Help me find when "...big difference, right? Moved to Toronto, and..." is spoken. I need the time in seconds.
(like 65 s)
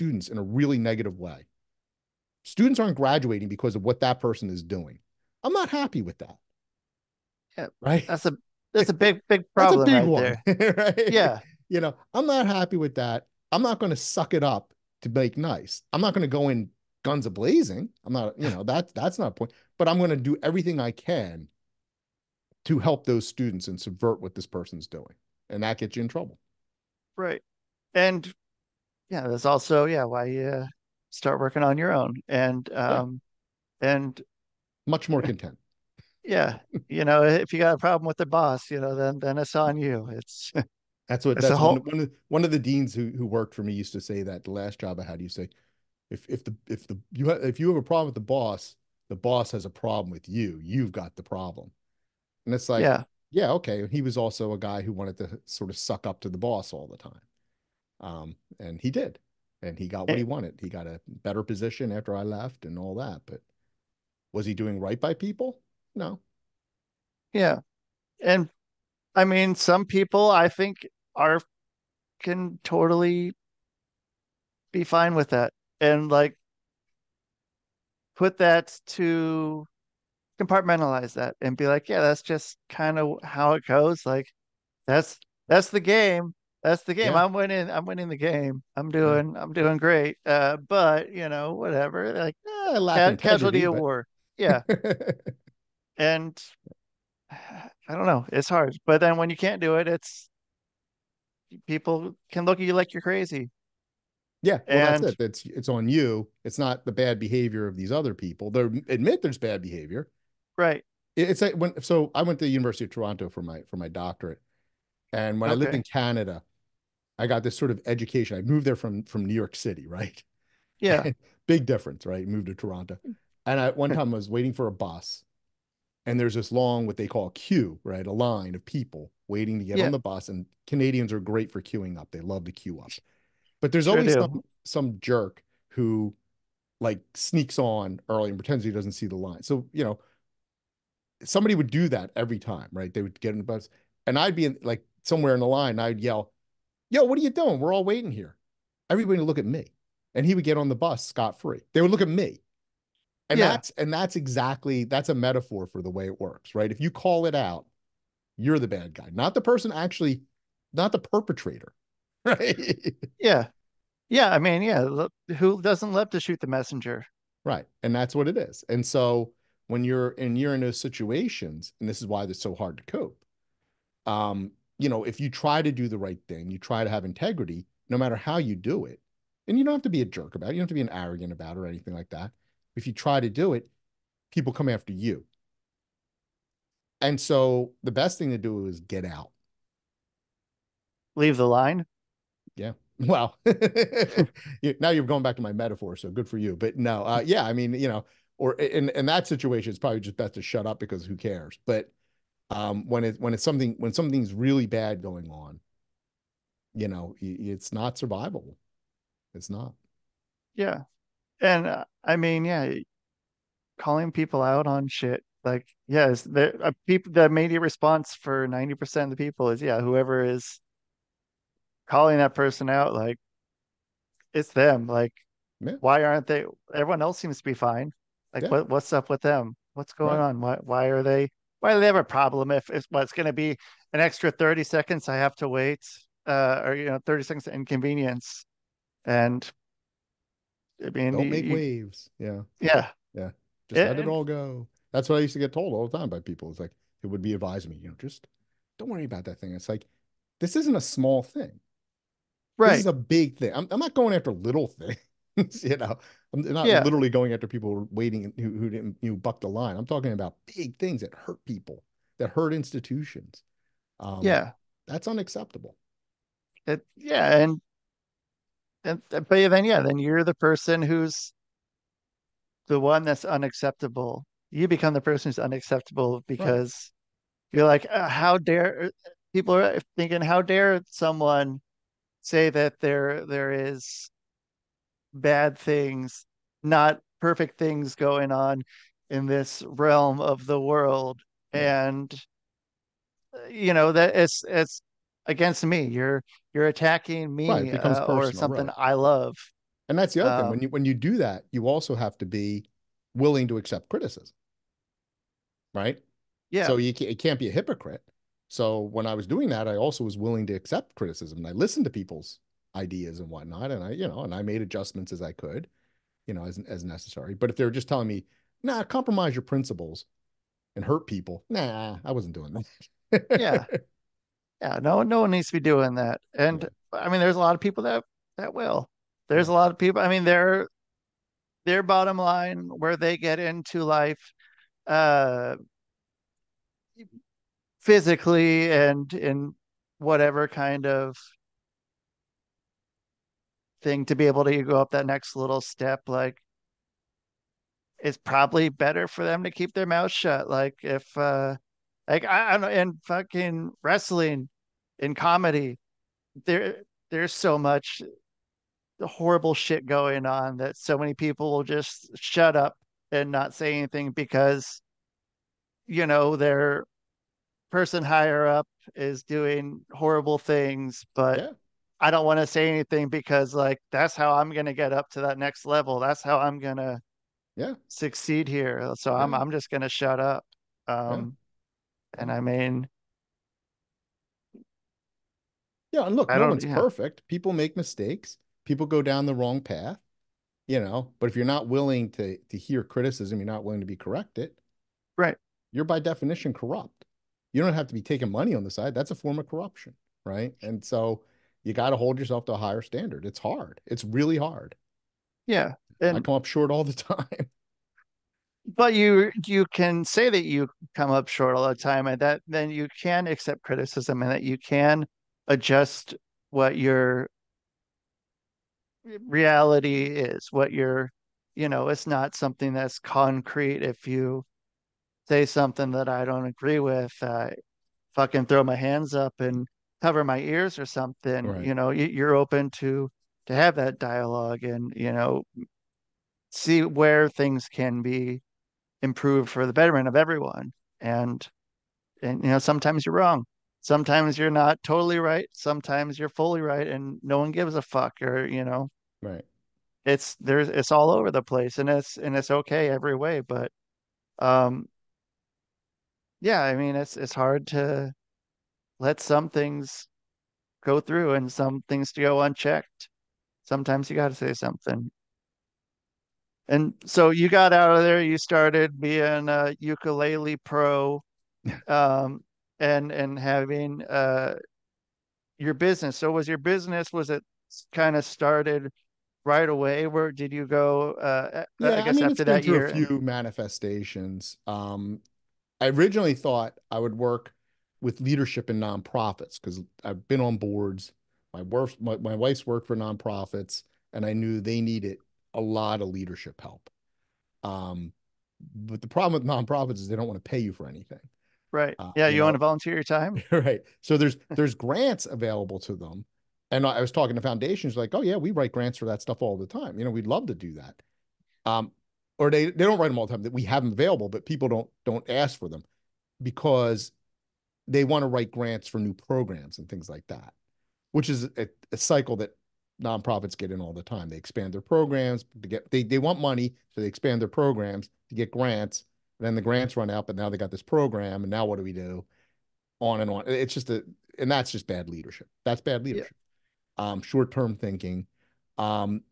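121 s.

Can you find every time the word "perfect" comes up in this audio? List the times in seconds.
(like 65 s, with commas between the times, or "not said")
287 s, 386 s.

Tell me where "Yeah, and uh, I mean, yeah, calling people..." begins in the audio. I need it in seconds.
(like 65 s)
210 s.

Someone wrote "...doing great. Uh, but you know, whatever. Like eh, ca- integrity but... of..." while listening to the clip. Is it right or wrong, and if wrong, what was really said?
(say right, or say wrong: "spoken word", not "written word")
wrong: "casualty", not "integrity".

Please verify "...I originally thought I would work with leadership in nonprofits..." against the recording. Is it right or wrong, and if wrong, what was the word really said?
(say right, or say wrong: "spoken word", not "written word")
right.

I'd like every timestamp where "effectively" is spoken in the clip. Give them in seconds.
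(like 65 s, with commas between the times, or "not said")
not said.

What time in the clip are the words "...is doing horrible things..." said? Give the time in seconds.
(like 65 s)
368 s.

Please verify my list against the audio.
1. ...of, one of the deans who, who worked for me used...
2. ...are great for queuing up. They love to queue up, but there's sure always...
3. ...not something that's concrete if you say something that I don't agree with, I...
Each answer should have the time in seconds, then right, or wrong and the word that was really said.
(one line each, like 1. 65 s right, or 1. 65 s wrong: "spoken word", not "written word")
1. 42 s right
2. 131 s right
3. 422 s right.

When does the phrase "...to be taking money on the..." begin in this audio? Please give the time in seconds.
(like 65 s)
397 s.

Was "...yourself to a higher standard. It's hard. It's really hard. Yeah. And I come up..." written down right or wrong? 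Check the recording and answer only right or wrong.
right.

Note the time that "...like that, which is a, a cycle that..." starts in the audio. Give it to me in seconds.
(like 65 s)
520 s.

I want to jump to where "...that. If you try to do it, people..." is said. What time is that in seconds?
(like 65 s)
182 s.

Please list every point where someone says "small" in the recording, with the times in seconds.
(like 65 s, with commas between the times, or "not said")
250 s.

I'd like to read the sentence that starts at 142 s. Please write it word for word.
They would get in the bus, and I'd be in, like somewhere in the line.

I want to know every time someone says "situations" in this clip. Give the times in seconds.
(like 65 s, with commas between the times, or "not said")
170 s, 199 s.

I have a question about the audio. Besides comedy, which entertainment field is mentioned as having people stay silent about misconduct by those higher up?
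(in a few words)
wrestling.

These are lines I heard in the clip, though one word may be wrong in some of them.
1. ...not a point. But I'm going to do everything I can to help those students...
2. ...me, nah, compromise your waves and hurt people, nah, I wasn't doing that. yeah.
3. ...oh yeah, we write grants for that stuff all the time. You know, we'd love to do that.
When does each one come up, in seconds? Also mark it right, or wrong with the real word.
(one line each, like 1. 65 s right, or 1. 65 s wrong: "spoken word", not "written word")
1. 19 s right
2. 318 s wrong: "principles", not "waves"
3. 508 s right.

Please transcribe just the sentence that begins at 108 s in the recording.
They admit there's bad behavior, Right.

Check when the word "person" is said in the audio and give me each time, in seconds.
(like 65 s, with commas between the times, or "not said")
4 s, 24 s, 159 s, 222 s, 270 s, 274 s, 367 s.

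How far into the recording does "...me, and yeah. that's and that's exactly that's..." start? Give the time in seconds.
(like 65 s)
152 s.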